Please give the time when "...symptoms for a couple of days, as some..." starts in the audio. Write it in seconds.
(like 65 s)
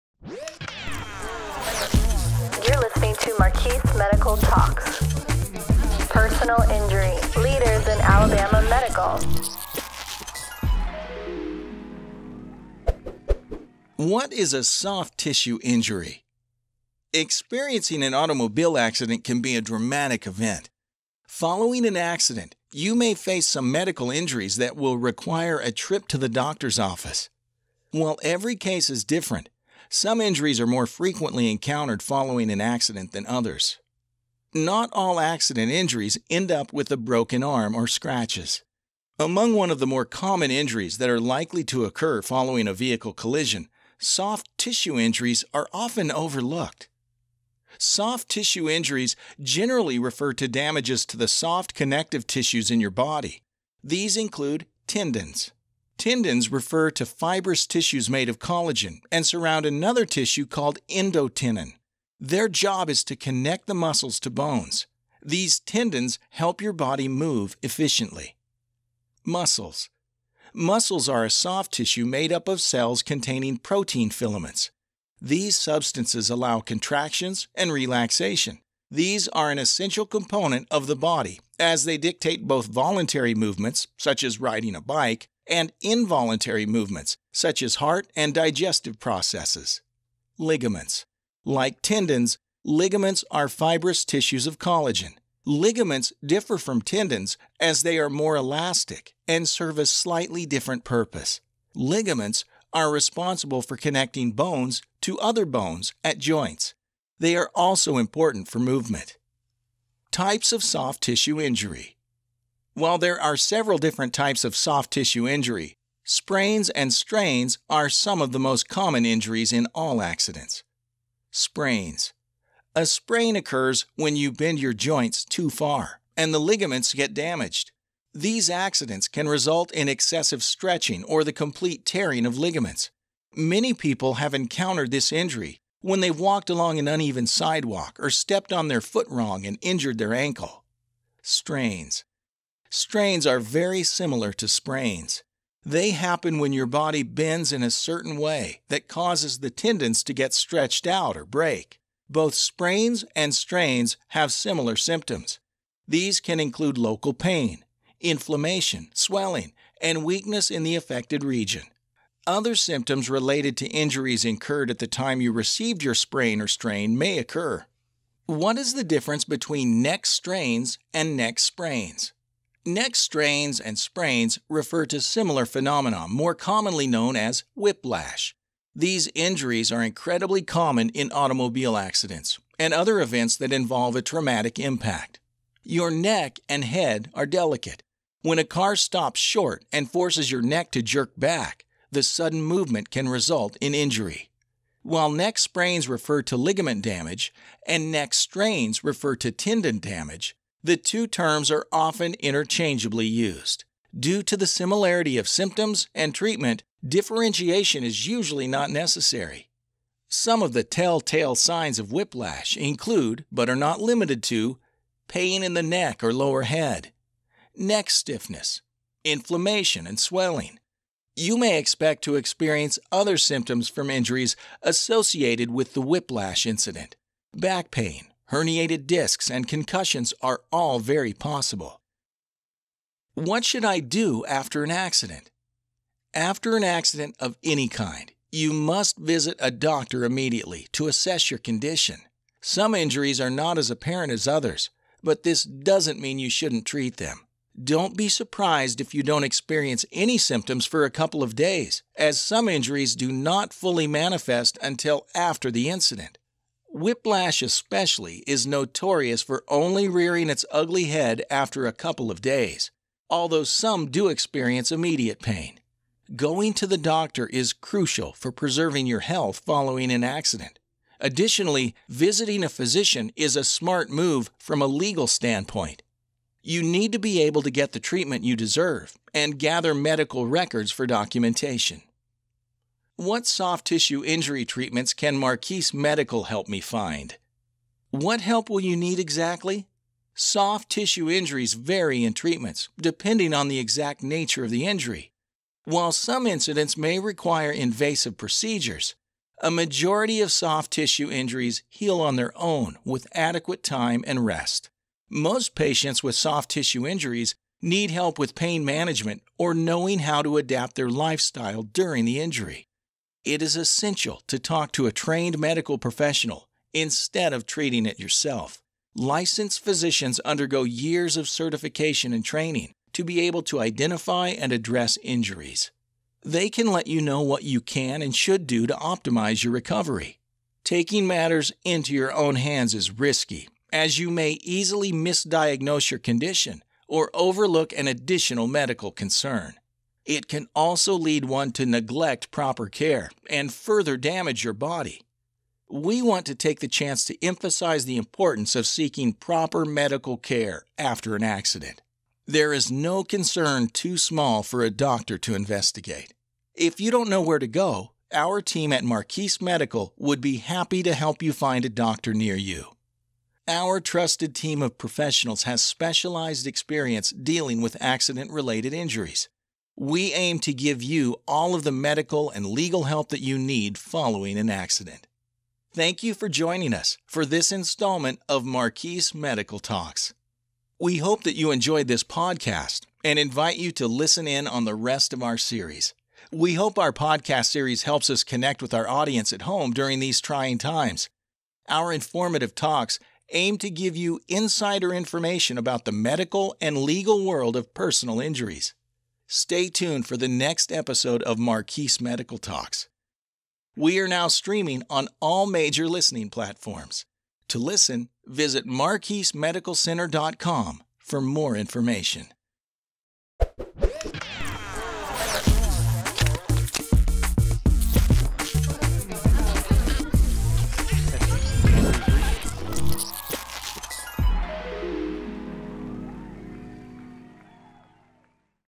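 250 s.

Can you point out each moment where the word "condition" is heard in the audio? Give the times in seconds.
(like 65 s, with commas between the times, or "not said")
241 s, 335 s.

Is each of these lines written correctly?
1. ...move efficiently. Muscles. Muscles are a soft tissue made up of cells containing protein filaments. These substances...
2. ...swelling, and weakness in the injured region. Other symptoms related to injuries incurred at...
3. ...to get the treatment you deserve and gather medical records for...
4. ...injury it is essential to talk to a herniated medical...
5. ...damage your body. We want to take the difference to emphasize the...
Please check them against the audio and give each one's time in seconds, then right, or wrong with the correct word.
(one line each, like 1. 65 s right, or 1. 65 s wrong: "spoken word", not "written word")
1. 67 s right
2. 158 s wrong: "affected", not "injured"
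3. 277 s right
4. 312 s wrong: "trained", not "herniated"
5. 343 s wrong: "chance", not "difference".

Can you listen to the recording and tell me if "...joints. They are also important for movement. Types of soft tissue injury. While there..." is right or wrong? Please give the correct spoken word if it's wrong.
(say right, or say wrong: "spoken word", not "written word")
right.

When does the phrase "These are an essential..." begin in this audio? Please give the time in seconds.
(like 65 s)
78 s.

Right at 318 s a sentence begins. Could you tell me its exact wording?
Licensed physicians undergo years of certification and training to be able to identify and address injuries.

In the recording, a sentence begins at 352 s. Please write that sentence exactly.
There is no concern too small for a doctor to investigate.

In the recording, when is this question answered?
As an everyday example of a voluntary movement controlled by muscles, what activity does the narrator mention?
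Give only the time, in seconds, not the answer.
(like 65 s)
84 s.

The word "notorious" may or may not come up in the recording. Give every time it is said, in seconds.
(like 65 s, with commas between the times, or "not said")
258 s.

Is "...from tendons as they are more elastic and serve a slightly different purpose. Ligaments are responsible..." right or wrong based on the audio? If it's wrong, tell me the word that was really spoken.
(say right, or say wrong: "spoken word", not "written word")
right.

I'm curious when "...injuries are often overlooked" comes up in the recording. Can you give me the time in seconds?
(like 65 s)
44 s.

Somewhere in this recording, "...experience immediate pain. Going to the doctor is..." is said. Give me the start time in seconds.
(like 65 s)
264 s.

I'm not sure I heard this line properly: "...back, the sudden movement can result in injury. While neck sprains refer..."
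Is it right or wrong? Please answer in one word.
right.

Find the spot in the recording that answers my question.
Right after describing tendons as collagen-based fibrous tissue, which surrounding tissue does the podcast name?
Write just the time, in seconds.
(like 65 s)
60 s.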